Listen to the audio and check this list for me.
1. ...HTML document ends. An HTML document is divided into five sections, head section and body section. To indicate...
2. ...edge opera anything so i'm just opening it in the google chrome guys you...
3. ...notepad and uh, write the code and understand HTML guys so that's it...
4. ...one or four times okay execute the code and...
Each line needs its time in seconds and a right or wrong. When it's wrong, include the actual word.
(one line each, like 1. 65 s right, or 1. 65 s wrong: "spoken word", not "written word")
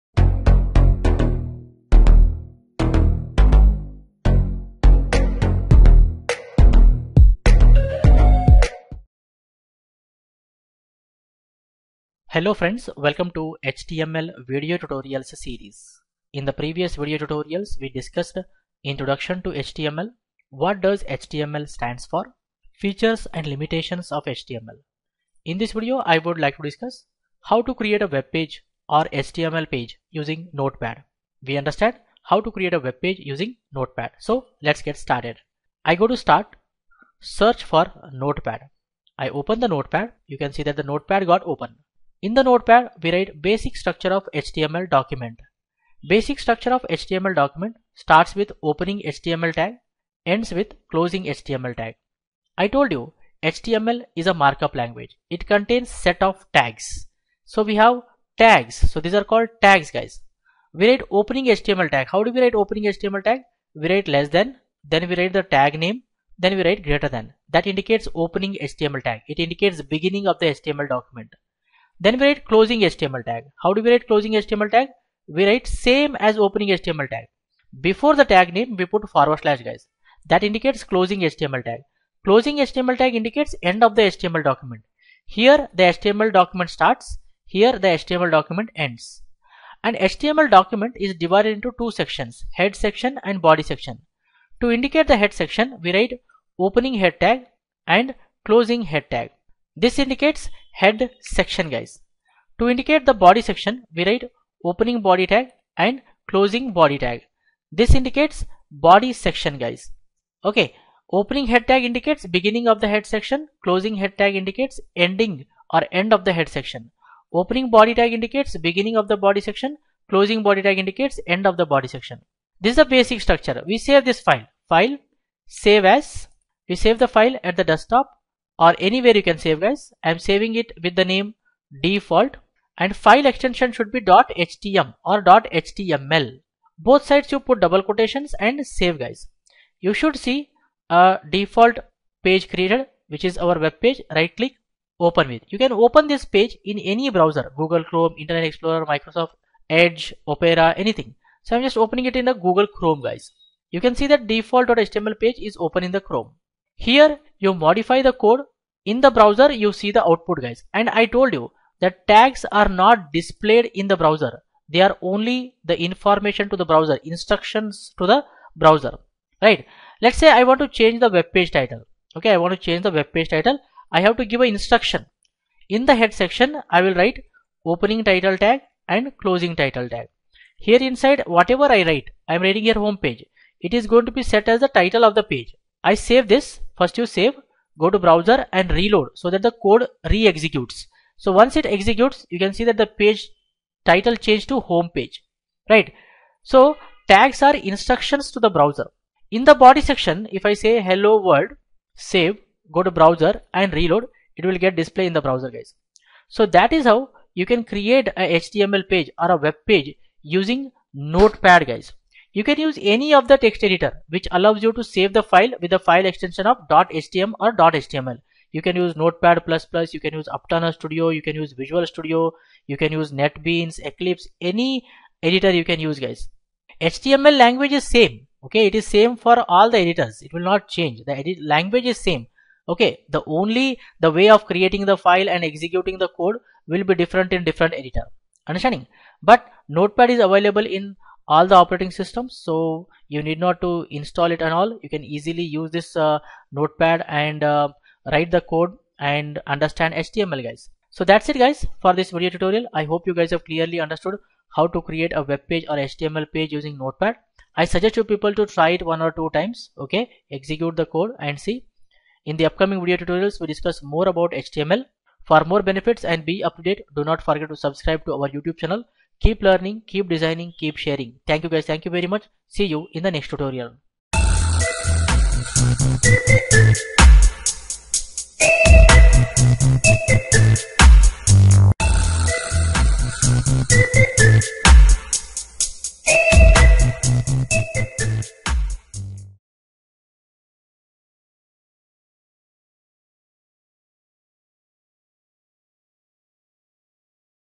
1. 87 s wrong: "two", not "five"
2. 149 s right
3. 246 s right
4. 258 s wrong: "two", not "four".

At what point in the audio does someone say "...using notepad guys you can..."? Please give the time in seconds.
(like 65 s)
210 s.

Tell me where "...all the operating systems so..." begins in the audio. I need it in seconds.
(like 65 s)
241 s.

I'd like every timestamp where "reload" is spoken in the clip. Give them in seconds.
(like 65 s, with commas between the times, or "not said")
188 s, 203 s.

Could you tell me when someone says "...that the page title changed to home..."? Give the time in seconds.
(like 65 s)
192 s.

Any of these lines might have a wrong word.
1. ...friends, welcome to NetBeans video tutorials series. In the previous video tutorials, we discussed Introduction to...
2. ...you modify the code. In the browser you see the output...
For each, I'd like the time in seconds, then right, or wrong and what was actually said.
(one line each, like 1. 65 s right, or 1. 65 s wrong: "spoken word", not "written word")
1. 12 s wrong: "HTML", not "NetBeans"
2. 157 s right.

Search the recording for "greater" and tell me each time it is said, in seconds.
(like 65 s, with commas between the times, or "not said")
66 s.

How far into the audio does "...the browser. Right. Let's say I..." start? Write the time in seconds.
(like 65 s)
168 s.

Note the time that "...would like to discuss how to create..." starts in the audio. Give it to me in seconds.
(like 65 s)
26 s.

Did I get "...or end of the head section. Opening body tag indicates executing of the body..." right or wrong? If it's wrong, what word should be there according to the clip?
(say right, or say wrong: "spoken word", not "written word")
wrong: "beginning", not "executing".